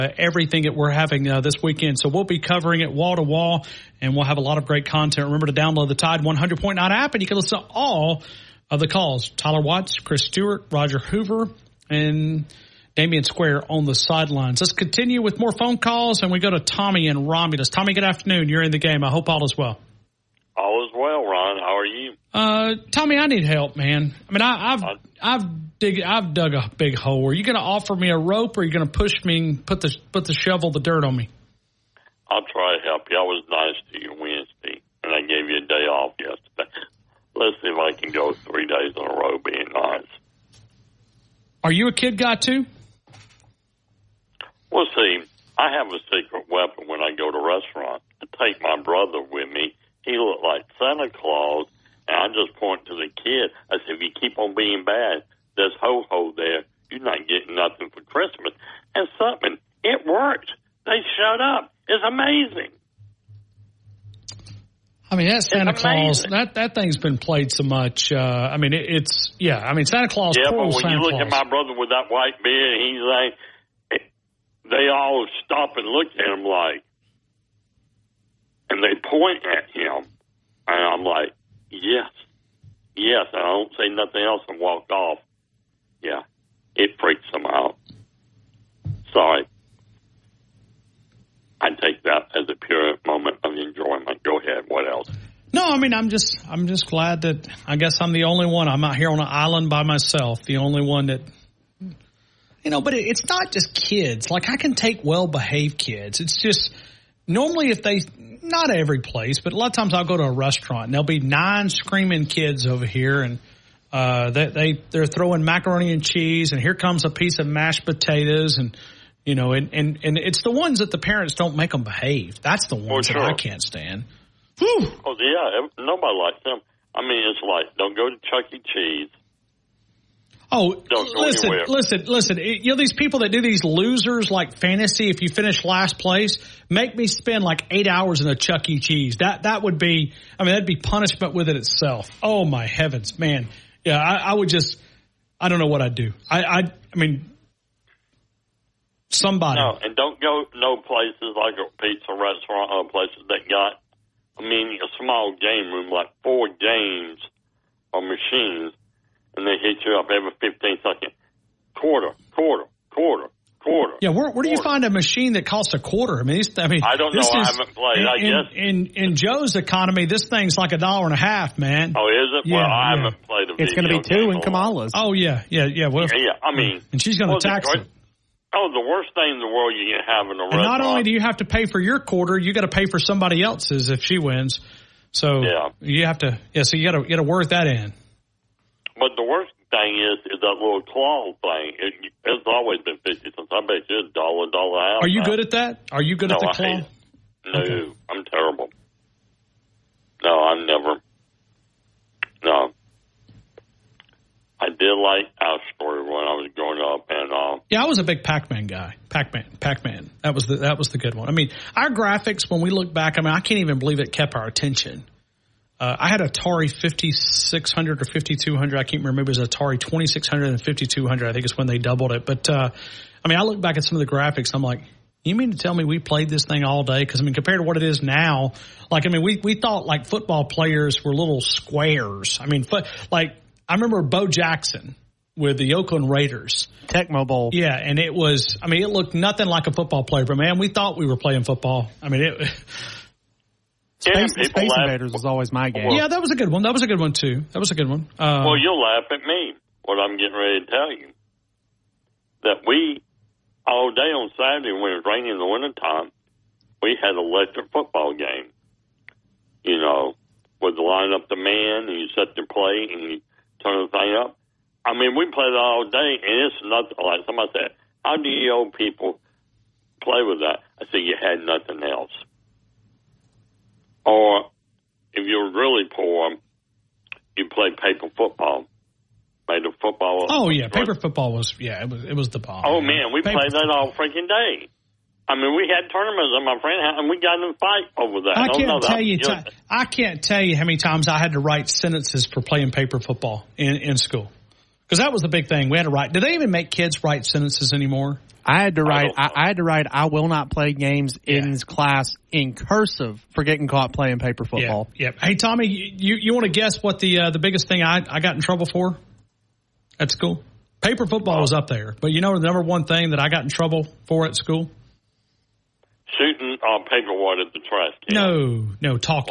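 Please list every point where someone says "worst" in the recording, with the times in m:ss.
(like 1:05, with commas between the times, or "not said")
2:58, 3:09.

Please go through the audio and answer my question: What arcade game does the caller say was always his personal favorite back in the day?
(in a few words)
Space Invaders.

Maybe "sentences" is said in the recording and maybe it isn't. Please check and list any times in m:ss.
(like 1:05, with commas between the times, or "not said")
4:51, 4:57.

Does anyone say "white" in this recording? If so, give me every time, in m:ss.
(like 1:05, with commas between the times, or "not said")
1:12, 5:17.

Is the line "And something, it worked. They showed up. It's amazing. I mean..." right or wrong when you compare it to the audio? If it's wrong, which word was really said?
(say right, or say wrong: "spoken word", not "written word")
right.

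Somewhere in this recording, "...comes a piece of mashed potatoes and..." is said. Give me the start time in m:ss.
1:56.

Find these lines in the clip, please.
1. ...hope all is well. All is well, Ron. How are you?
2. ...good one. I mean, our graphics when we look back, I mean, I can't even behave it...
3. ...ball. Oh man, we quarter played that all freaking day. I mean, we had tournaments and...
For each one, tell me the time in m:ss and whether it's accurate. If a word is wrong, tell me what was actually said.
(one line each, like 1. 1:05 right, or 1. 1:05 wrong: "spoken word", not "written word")
1. 0:19 right
2. 3:30 wrong: "believe", not "behave"
3. 4:42 wrong: "paper", not "quarter".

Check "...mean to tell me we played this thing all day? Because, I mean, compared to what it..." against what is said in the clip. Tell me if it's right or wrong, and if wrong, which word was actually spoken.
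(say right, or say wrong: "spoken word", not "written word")
right.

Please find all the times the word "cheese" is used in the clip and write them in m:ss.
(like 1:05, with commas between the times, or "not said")
1:56, 2:08, 2:18.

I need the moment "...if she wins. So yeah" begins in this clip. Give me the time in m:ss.
3:03.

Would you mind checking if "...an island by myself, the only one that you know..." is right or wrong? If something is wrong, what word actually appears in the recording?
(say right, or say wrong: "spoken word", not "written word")
right.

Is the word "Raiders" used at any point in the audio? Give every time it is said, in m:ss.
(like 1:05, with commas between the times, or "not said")
3:56.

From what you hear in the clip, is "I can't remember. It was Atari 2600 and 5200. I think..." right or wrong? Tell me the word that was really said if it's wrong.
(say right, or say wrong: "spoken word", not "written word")
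right.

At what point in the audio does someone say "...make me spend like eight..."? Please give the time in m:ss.
2:16.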